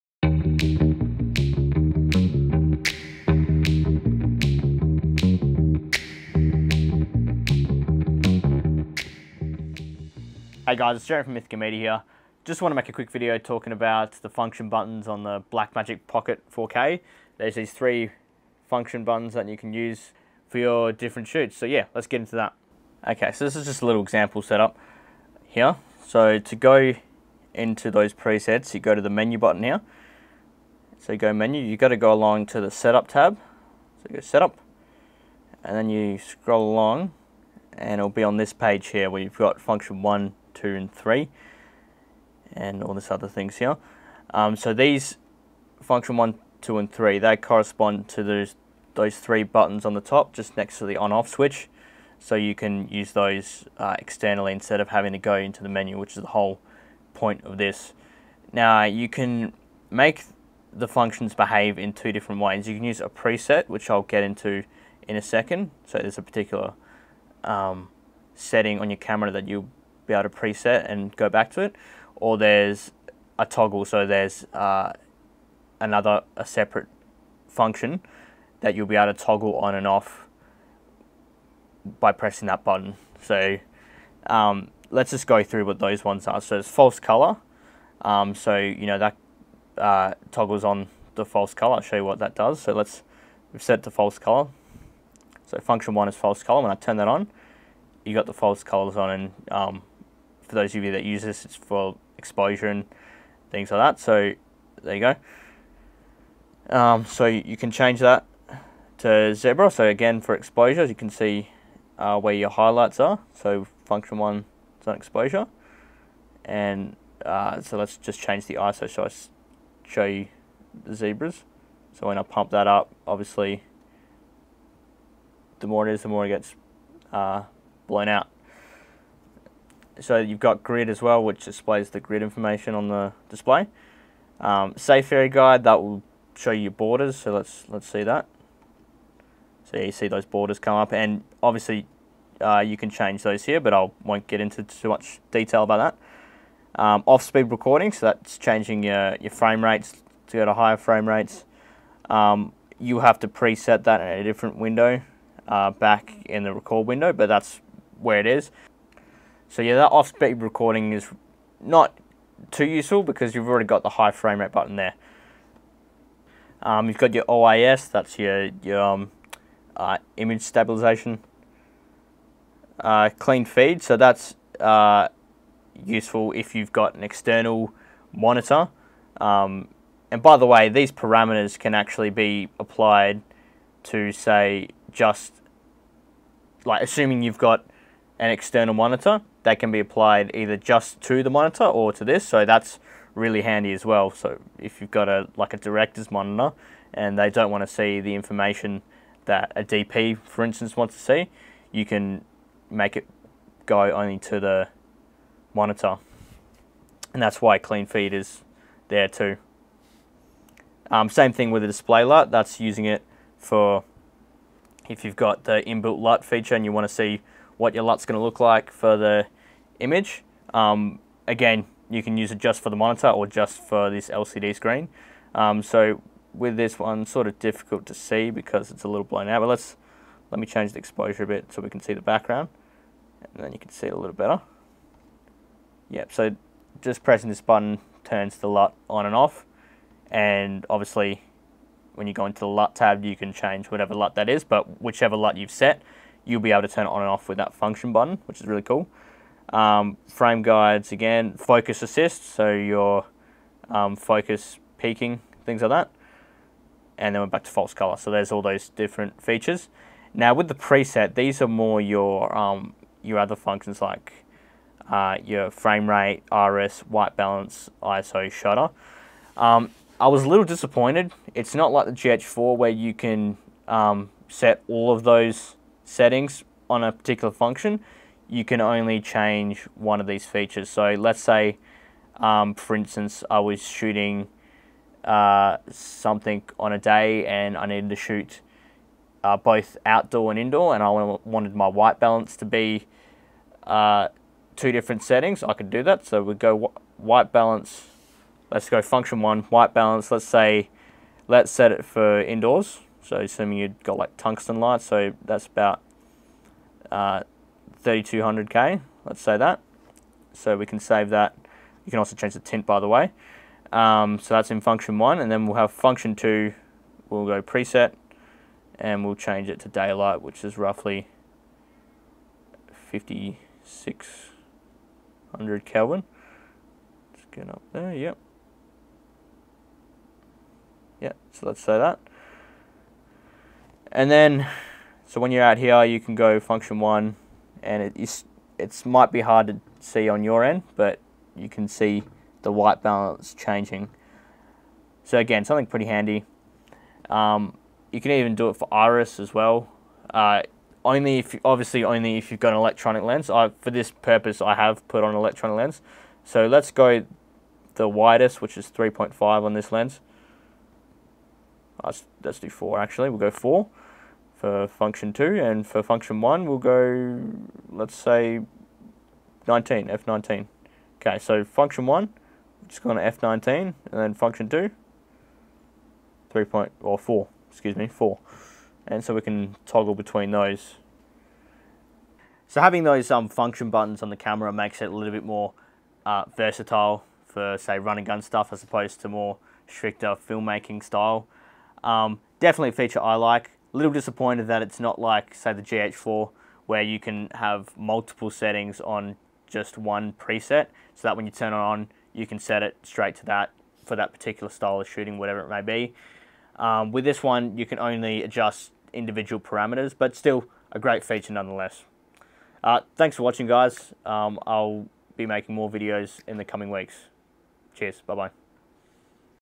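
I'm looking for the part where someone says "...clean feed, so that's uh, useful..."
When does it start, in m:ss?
2:53.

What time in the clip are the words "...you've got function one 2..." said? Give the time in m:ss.
0:39.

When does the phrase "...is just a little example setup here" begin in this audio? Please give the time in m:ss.
0:23.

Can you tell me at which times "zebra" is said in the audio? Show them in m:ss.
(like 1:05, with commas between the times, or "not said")
1:49, 2:00.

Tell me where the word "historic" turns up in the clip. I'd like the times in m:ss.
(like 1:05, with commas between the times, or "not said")
not said.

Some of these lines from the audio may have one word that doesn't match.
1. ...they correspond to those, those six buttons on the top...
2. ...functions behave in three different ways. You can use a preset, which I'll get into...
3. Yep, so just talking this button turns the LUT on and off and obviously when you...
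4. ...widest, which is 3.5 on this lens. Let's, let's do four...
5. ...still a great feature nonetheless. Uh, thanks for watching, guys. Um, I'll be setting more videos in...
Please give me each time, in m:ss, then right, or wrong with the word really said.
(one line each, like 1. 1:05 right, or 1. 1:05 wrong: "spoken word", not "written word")
1. 0:47 wrong: "three", not "six"
2. 1:00 wrong: "two", not "three"
3. 3:55 wrong: "pressing", not "talking"
4. 5:57 right
5. 6:50 wrong: "making", not "setting".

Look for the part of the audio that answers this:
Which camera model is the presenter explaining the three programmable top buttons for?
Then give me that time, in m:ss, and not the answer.
0:15.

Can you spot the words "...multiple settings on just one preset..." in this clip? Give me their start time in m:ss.
6:37.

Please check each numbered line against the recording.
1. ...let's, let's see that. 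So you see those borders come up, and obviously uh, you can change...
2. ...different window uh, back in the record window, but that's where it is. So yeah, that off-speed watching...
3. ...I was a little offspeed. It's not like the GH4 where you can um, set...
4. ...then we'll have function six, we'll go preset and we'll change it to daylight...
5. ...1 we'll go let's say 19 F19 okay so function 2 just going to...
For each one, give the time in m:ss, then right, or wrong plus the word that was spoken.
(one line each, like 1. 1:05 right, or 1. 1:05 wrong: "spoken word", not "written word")
1. 2:17 right
2. 2:34 wrong: "recording", not "watching"
3. 4:29 wrong: "disappointed", not "offspeed"
4. 5:15 wrong: "two", not "six"
5. 6:06 wrong: "1", not "2".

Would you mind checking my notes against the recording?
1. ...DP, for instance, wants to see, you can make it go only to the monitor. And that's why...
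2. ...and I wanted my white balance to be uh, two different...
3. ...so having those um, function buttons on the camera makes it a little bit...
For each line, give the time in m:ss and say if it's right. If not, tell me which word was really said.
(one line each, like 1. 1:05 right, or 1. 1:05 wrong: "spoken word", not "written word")
1. 3:19 right
2. 4:50 right
3. 6:22 right.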